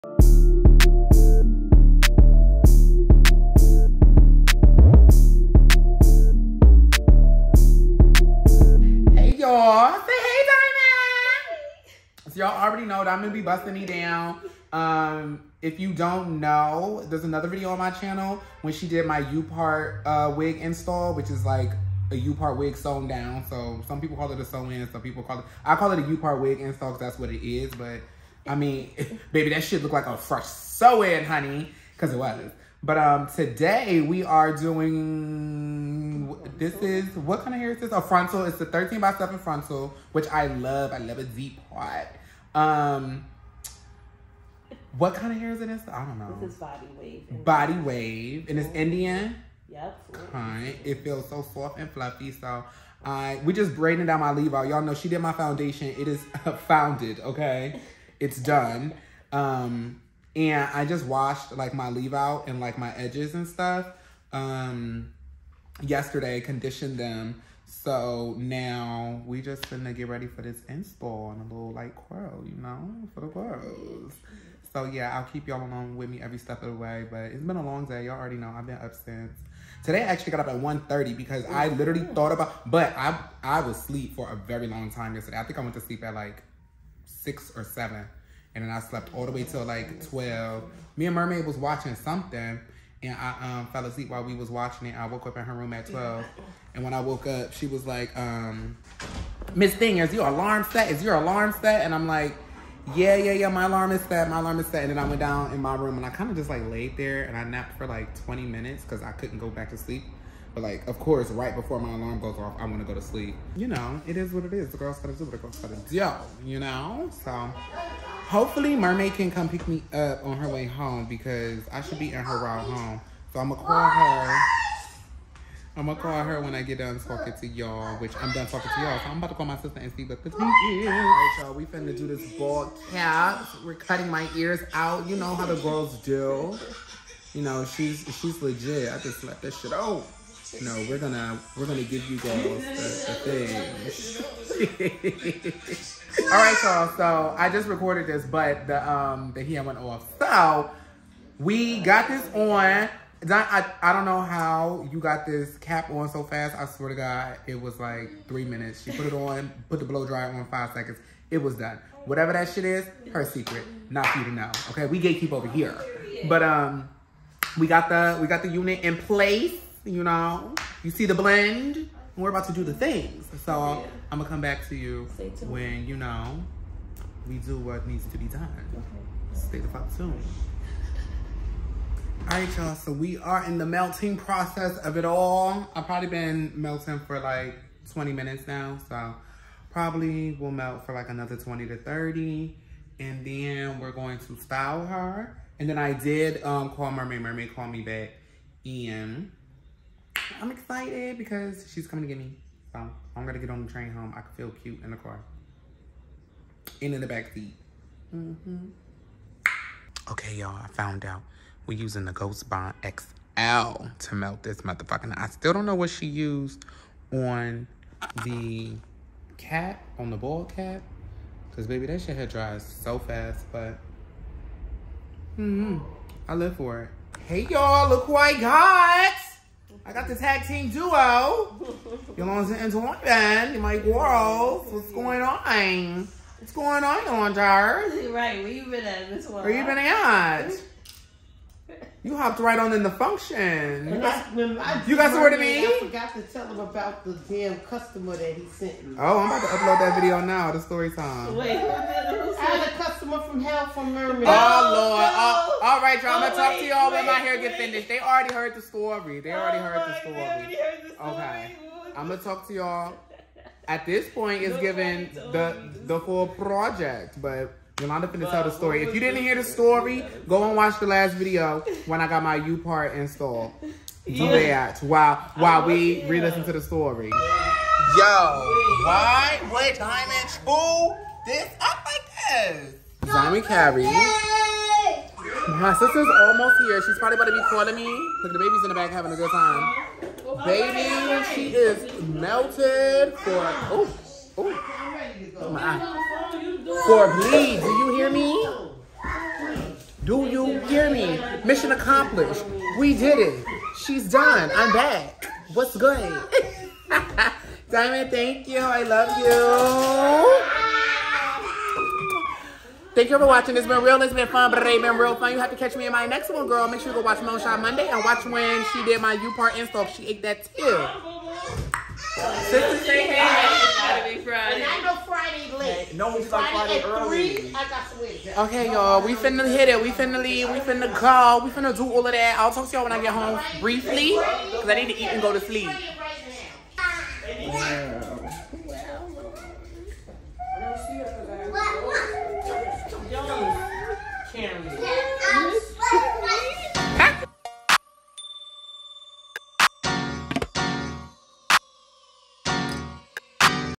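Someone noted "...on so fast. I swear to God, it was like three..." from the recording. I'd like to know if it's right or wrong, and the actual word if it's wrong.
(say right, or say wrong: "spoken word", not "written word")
right.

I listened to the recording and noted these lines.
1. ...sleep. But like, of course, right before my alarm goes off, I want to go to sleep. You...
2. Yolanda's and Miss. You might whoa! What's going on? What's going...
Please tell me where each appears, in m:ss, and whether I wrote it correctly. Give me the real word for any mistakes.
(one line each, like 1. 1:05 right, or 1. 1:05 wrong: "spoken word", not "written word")
1. 1:49 right
2. 3:52 wrong: "Jordan", not "Miss".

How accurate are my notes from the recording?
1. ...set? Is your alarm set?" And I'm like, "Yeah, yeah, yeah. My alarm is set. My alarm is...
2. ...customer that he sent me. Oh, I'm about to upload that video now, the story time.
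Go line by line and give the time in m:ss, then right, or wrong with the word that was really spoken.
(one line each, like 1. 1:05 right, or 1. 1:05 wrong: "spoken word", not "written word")
1. 1:40 right
2. 4:07 right.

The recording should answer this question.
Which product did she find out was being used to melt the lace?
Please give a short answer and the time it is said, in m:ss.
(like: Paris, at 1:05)
Ghost Bond XL, at 3:32.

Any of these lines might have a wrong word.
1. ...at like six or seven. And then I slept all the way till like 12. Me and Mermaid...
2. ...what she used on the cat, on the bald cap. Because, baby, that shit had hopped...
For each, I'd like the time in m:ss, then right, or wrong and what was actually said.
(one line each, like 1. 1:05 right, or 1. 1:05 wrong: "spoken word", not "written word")
1. 1:26 right
2. 3:35 wrong: "dried", not "hopped".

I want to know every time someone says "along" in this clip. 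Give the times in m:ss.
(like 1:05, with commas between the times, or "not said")
1:15.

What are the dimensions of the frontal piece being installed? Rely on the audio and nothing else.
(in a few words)
13 by 7.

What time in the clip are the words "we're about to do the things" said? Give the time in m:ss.
2:52.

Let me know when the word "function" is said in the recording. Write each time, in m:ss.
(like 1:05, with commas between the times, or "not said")
4:02.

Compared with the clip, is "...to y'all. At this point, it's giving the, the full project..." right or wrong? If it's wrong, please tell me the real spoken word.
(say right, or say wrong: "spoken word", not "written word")
right.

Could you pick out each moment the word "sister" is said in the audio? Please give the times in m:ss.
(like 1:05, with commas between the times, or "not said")
2:09, 4:45, 5:22.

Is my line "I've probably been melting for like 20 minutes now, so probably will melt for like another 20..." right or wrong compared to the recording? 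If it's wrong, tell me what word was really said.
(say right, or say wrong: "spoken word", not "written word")
right.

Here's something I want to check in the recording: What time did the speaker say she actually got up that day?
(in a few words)
1:30.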